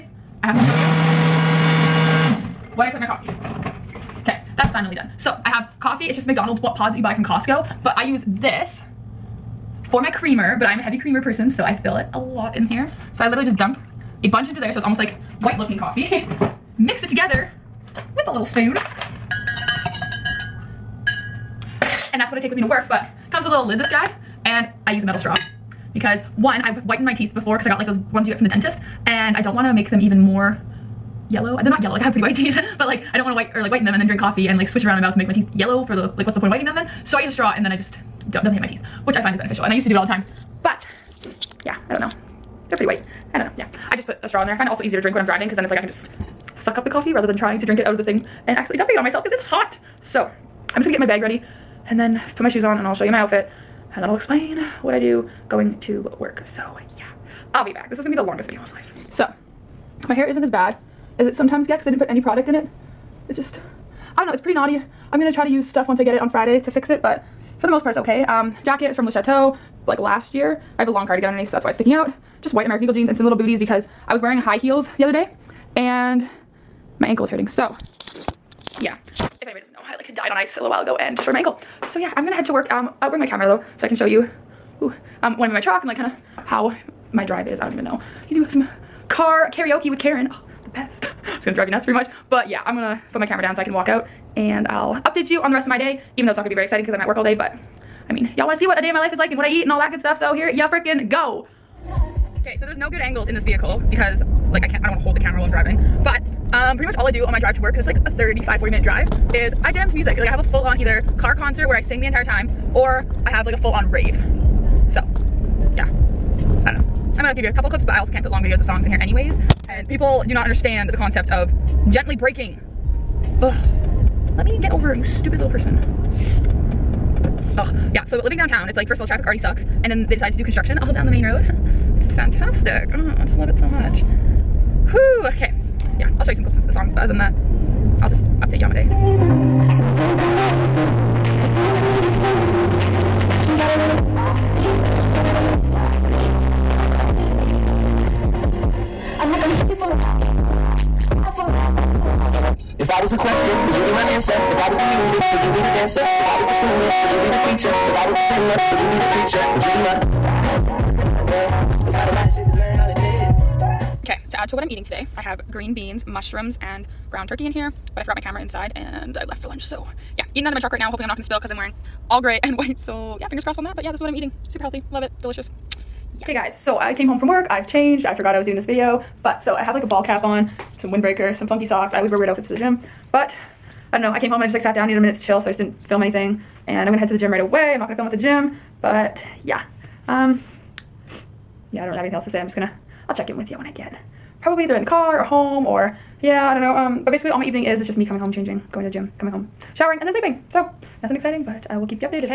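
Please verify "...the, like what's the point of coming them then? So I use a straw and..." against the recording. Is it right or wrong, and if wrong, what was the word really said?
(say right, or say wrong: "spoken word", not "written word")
wrong: "whitening", not "coming".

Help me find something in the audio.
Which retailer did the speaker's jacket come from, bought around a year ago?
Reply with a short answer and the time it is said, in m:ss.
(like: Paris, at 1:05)
Le Chateau, at 1:09.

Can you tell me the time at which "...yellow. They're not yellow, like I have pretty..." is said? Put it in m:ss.
0:31.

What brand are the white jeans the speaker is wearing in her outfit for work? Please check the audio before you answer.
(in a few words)
American Eagle.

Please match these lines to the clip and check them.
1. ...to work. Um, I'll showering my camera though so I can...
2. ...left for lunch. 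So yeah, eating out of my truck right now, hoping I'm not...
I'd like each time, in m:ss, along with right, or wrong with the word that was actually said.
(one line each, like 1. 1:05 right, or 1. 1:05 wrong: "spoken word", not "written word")
1. 1:22 wrong: "bring", not "showering"
2. 2:49 right.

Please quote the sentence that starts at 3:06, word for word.
And I'm gonna head to the gym right away.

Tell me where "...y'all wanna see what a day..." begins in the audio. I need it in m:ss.
1:38.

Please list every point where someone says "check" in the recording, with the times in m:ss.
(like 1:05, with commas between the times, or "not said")
3:13.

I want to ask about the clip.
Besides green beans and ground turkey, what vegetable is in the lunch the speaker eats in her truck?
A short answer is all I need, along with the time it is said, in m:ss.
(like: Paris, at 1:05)
Mushrooms, at 2:46.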